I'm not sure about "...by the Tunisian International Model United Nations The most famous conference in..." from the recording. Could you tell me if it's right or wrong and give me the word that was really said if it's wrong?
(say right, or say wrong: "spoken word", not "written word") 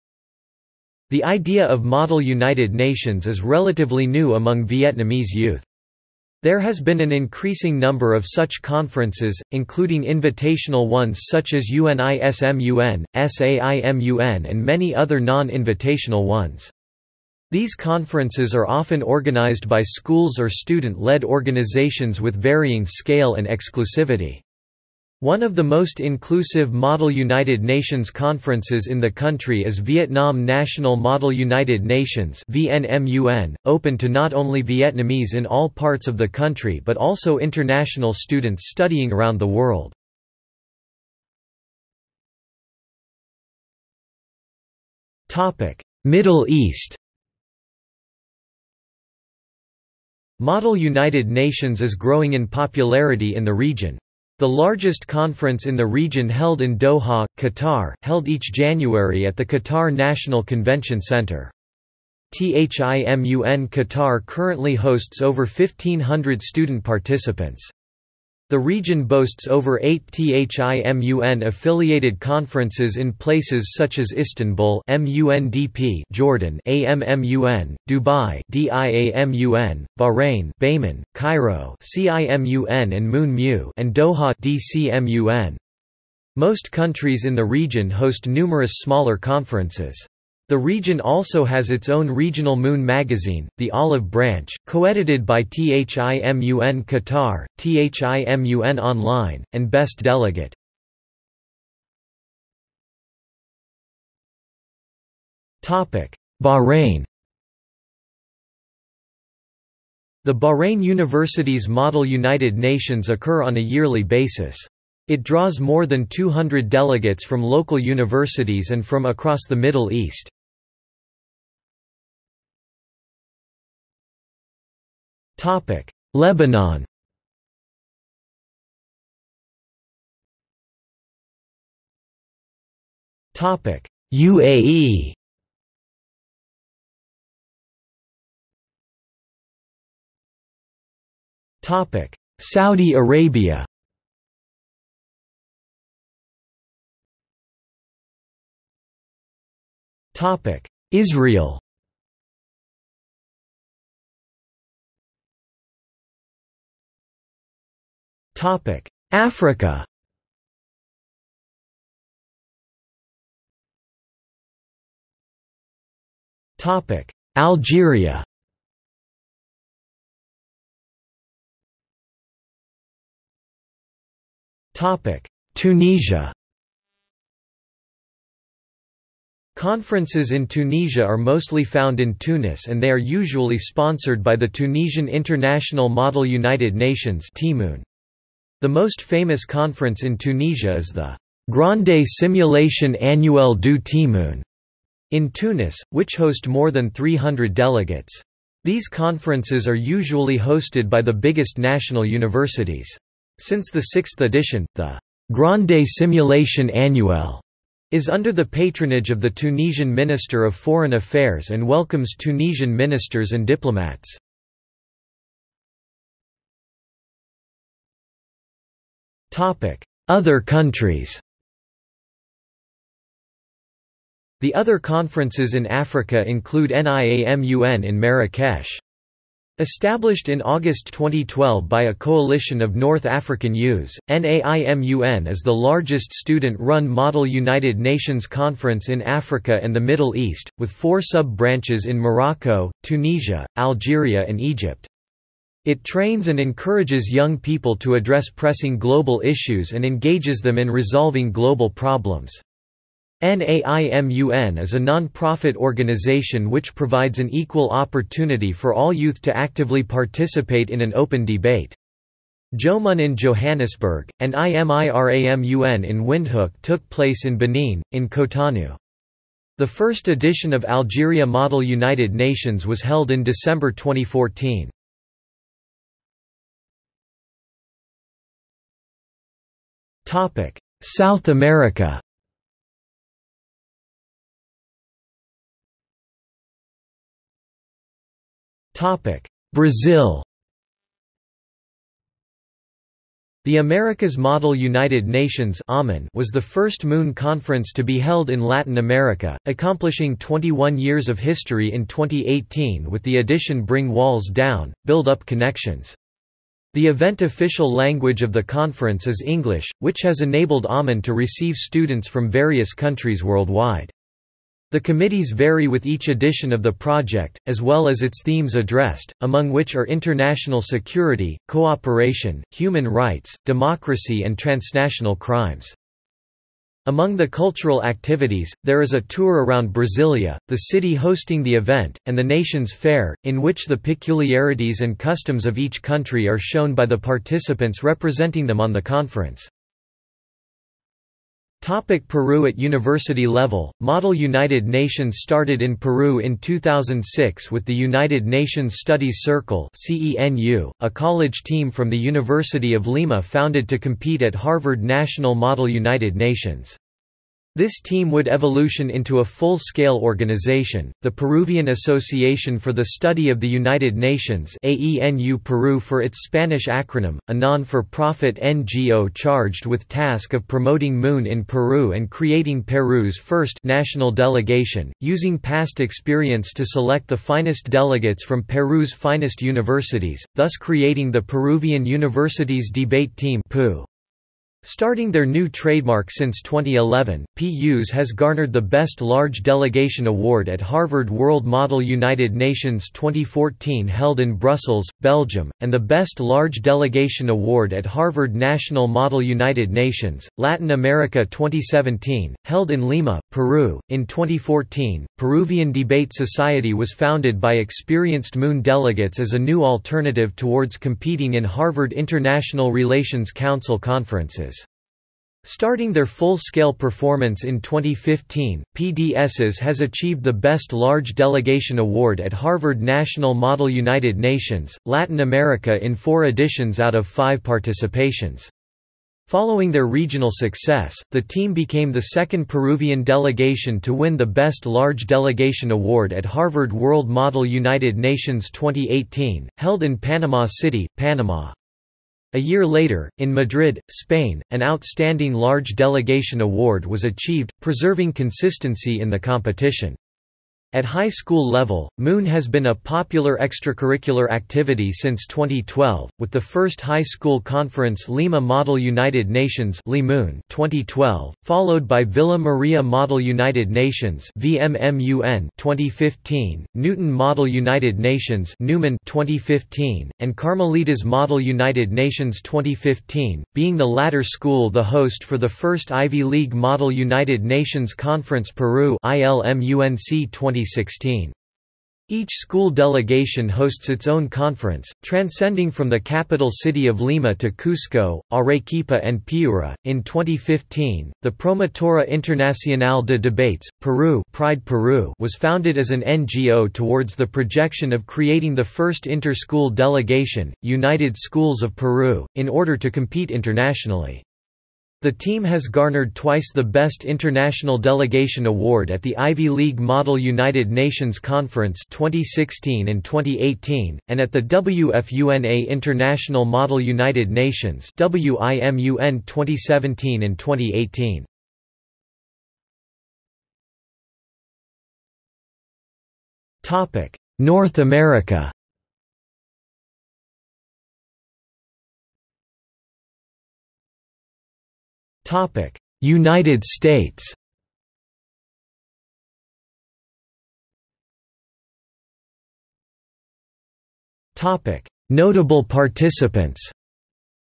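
right.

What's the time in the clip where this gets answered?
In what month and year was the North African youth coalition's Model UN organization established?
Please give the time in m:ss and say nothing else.
3:50.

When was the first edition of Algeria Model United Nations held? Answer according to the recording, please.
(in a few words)
December 2014.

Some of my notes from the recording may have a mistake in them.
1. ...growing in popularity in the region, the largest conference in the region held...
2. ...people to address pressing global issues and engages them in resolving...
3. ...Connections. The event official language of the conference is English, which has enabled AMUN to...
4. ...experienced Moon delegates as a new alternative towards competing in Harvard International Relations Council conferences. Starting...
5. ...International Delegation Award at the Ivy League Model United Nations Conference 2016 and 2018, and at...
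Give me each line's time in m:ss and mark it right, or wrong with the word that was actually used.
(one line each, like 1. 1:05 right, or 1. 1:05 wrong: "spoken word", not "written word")
1. 0:51 right
2. 4:07 right
3. 5:05 right
4. 6:47 right
5. 8:27 right.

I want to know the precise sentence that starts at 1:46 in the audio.
Bahrain The Bahrain University's Model United Nations occur on a yearly basis.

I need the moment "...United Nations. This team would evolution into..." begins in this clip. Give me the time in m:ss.
5:55.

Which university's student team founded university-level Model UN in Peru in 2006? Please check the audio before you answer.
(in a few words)
University of Lima.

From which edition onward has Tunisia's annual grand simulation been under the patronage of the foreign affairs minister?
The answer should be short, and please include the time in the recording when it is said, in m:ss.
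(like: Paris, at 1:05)
sixth, at 3:23.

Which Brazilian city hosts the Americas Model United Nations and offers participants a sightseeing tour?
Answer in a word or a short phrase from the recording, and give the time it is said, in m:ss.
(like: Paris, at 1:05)
Brasilia, at 5:29.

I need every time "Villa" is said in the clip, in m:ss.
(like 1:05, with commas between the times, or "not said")
7:42.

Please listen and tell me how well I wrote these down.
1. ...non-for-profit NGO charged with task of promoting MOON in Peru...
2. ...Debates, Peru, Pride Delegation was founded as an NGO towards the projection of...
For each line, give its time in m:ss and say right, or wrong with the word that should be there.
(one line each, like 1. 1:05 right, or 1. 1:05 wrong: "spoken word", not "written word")
1. 6:07 right
2. 8:13 wrong: "Peru", not "Delegation".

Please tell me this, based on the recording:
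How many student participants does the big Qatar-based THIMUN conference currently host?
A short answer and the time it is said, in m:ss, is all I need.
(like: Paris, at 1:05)
over 1,500, at 1:05.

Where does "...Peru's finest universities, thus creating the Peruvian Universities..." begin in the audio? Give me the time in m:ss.
6:18.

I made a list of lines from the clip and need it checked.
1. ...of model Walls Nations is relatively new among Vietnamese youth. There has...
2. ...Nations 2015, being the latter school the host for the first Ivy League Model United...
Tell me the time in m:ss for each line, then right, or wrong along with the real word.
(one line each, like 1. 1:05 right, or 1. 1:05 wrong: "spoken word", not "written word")
1. 0:01 wrong: "United", not "Walls"
2. 7:51 right.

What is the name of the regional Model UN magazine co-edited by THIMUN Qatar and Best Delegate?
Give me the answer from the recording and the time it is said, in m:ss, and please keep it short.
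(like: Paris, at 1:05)
The Olive Branch, at 1:33.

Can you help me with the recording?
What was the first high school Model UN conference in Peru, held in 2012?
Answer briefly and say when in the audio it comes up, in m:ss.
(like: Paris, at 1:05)
Lima Model United Nations, at 7:38.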